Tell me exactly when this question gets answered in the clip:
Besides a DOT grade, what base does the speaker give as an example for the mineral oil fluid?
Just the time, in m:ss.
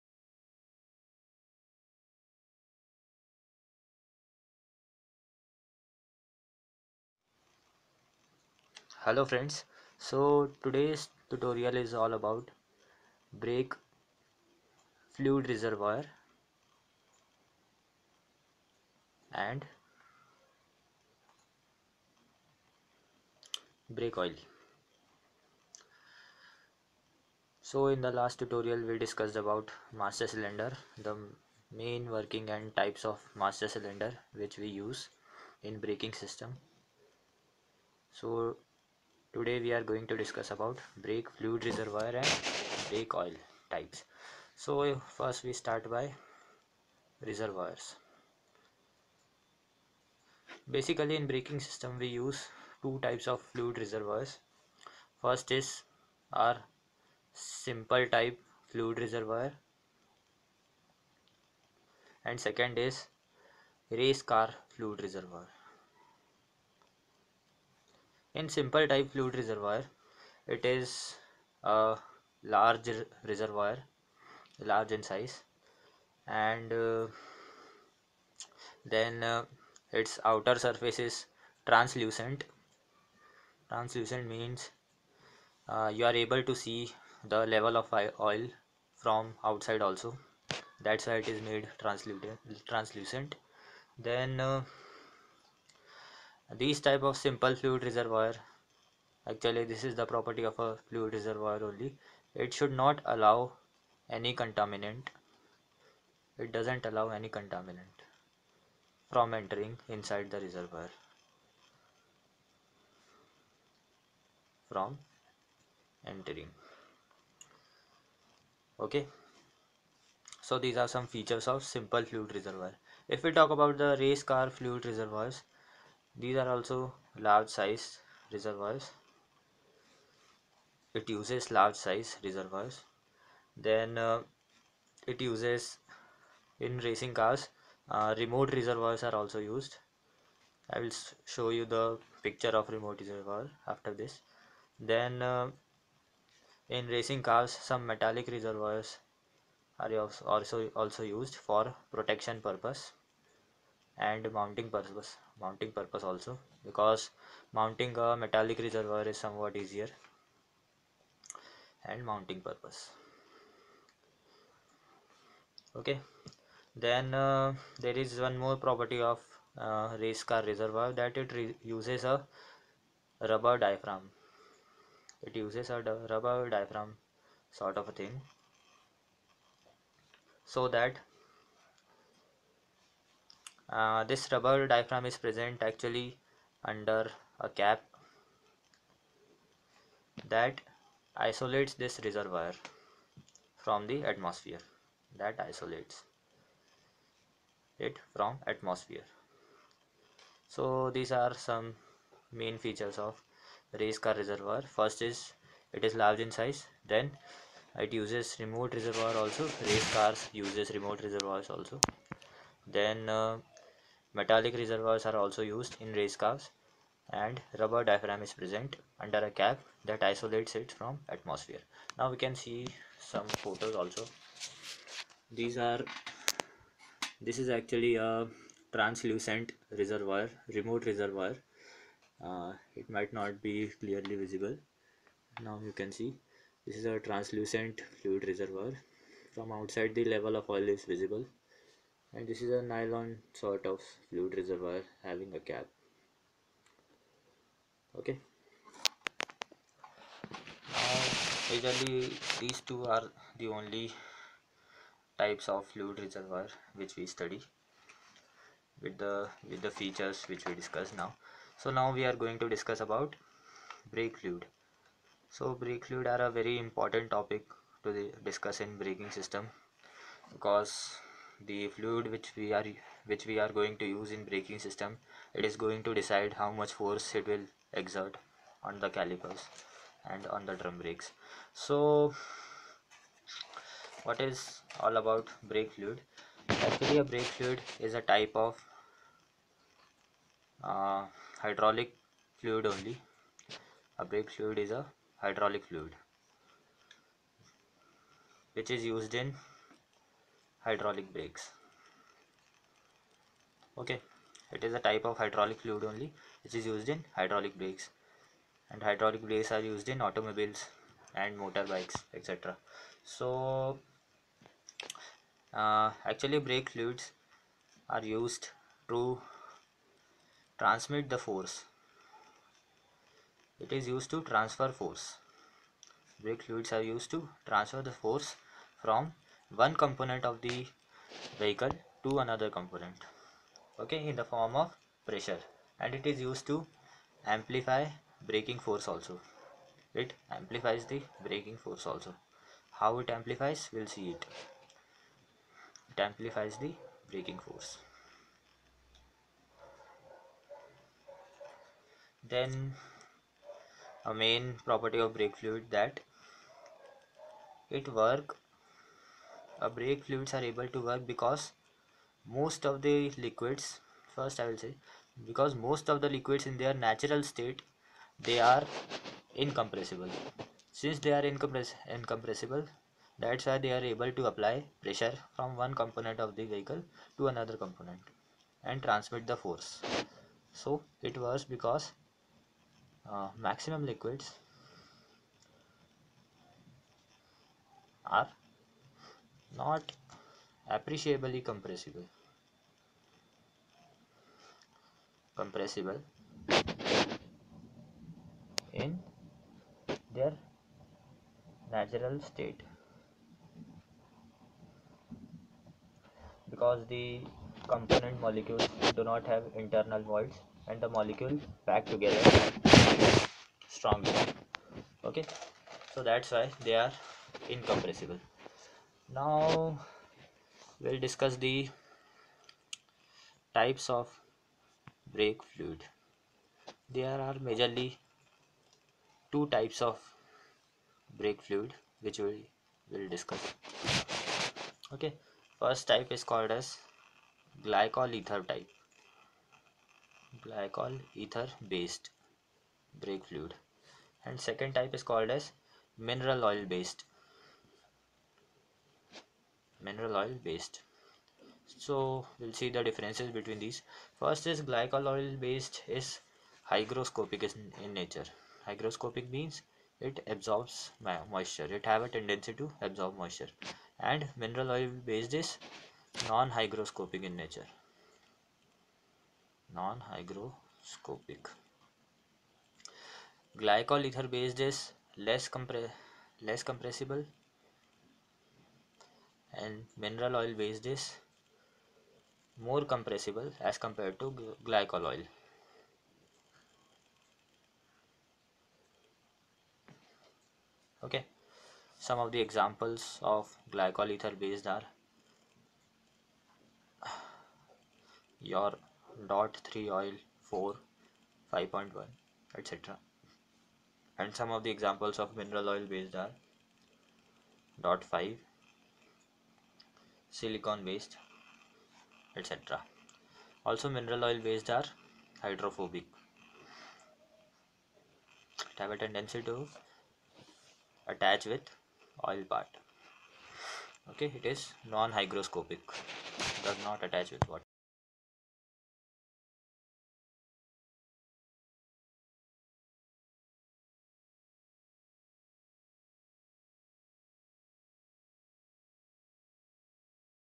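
8:30.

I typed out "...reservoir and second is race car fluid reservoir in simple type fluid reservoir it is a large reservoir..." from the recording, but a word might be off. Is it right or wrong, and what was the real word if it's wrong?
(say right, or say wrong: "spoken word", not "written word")
right.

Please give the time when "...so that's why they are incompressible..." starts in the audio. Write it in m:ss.
6:55.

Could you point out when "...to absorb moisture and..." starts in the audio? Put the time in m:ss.
7:42.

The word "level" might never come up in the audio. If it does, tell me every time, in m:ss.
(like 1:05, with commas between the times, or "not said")
1:27, 4:00.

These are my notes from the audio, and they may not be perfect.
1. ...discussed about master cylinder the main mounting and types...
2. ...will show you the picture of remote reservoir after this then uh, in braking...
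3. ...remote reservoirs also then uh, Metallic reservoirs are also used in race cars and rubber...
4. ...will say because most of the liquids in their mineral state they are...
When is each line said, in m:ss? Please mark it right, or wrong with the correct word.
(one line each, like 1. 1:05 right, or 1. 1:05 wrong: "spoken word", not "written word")
1. 0:29 wrong: "working", not "mounting"
2. 2:20 wrong: "racing", not "braking"
3. 3:30 right
4. 6:04 wrong: "natural", not "mineral".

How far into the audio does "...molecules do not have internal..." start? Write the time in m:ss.
6:48.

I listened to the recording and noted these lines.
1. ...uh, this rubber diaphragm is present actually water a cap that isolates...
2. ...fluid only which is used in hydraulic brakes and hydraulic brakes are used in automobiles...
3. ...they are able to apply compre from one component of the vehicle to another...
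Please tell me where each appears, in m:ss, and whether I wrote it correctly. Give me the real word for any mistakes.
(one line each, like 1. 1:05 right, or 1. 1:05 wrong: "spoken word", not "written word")
1. 3:03 wrong: "under", not "water"
2. 5:05 right
3. 6:13 wrong: "pressure", not "compre".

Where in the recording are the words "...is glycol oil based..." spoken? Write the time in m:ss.
7:34.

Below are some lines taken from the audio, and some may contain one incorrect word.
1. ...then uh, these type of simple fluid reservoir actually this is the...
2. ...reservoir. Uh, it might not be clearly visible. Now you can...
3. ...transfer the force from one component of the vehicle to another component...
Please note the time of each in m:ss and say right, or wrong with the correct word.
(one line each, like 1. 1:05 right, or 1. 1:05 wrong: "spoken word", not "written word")
1. 1:33 right
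2. 3:50 right
3. 5:27 right.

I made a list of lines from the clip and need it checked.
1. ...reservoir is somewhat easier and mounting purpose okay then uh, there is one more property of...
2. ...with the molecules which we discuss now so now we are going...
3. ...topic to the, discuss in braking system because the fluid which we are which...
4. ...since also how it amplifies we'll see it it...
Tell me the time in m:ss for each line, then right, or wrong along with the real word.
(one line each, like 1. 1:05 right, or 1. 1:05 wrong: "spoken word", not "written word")
1. 2:38 right
2. 4:19 wrong: "features", not "molecules"
3. 4:27 right
4. 5:41 wrong: "force", not "since".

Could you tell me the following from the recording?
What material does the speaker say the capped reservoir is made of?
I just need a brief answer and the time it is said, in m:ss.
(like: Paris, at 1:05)
Nylon, at 4:02.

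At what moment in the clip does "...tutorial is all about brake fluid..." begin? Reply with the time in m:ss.
0:11.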